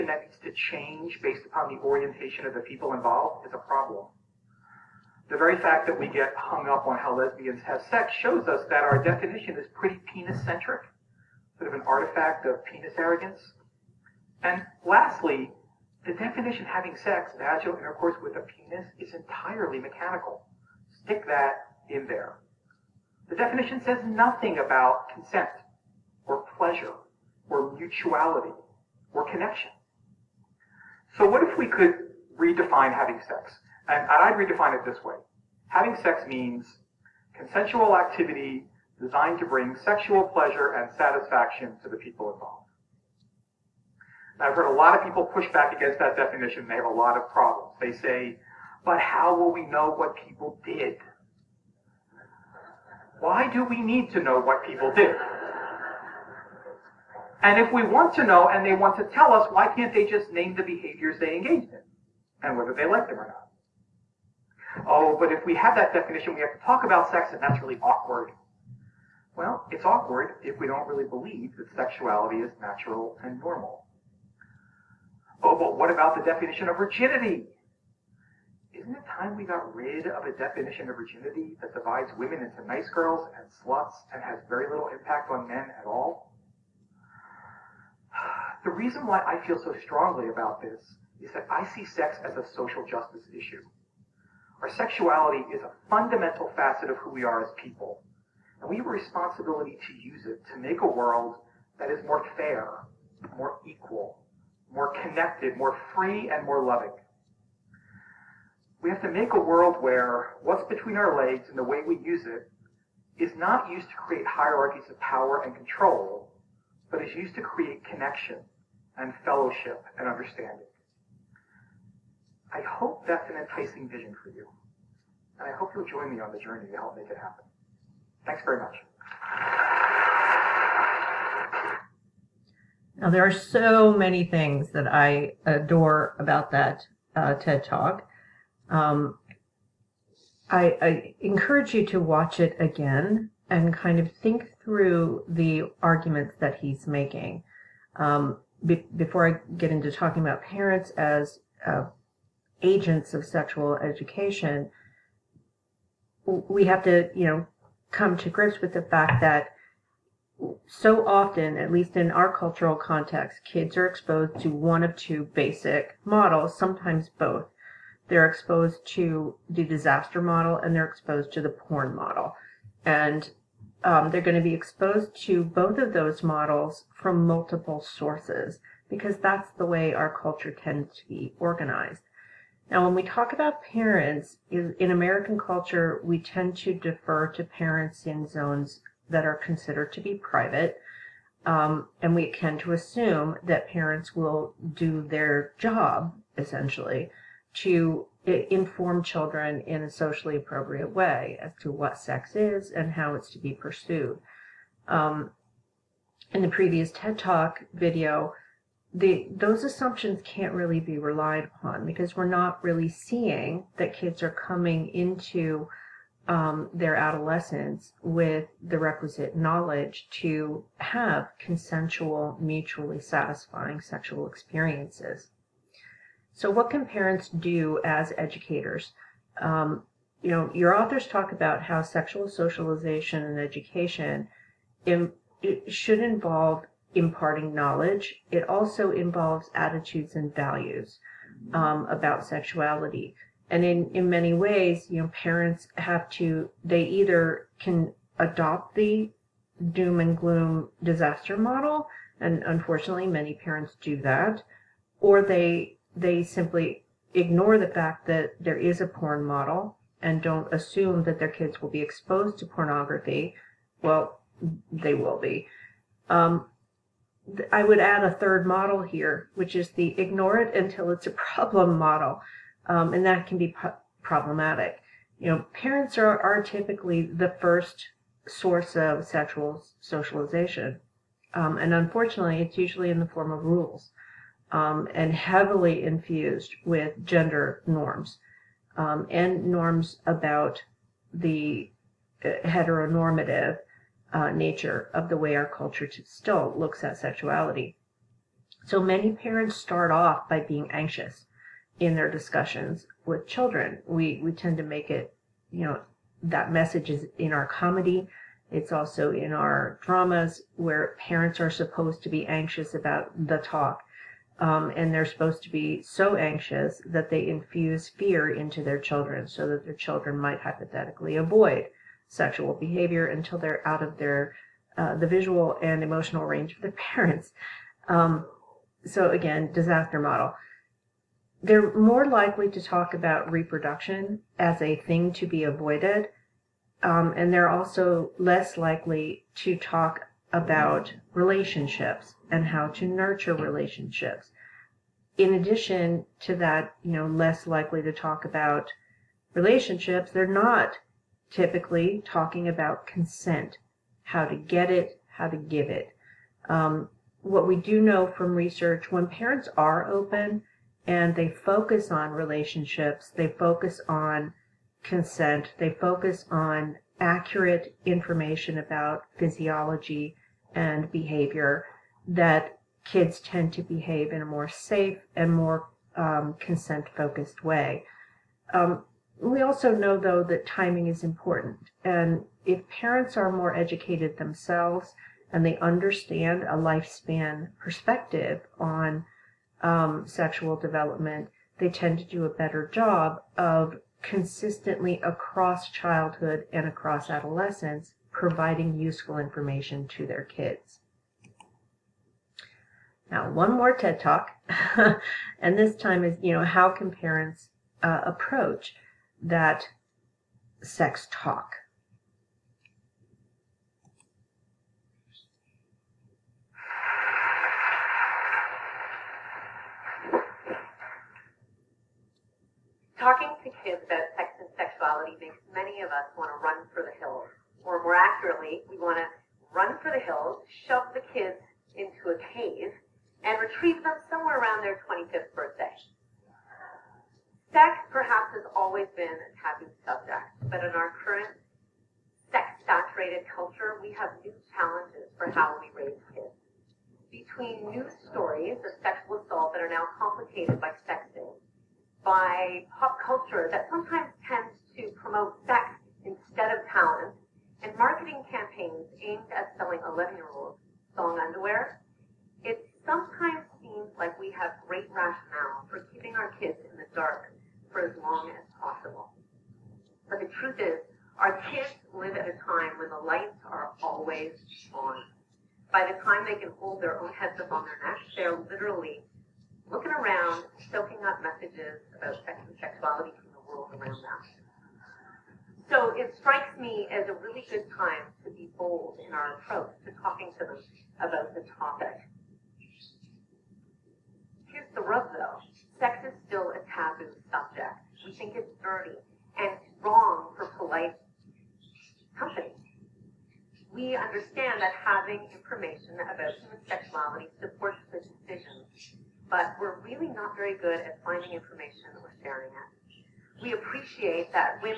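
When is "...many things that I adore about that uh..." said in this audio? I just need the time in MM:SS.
02:13.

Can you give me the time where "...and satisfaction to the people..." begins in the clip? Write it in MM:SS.
00:40.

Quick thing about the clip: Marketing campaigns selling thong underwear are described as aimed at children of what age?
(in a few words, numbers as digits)
11.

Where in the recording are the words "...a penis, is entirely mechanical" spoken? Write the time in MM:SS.
00:18.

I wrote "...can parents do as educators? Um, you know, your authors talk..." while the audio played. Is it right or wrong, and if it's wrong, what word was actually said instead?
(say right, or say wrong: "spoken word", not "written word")
right.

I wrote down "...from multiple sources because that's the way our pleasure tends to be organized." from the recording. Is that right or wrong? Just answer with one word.
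wrong.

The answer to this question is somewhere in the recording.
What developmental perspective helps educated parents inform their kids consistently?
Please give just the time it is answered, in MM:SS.
06:26.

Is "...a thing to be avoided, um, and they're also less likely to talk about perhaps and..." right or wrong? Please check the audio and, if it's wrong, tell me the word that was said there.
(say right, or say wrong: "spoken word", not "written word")
wrong: "relationships", not "perhaps".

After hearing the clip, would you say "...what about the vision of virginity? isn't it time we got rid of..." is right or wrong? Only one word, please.
wrong.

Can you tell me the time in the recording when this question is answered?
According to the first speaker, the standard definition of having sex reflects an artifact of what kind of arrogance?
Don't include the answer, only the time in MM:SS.
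00:12.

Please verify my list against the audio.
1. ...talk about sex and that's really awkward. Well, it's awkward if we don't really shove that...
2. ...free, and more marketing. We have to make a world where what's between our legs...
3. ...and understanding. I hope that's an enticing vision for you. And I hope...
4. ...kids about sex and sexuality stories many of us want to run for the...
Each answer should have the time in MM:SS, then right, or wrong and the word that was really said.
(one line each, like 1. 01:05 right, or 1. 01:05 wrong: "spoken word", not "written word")
1. 01:06 wrong: "believe", not "shove"
2. 01:45 wrong: "loving", not "marketing"
3. 01:59 right
4. 07:03 wrong: "makes", not "stories".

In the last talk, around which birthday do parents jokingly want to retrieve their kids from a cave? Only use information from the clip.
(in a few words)
25th.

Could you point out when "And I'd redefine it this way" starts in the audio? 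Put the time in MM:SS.
00:33.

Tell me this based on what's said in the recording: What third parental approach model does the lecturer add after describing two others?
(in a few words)
Ignore it until it's a problem.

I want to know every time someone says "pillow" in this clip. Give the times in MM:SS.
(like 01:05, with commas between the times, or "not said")
not said.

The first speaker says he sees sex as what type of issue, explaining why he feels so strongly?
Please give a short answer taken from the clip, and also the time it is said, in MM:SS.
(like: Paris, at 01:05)
Social justice issue, at 01:32.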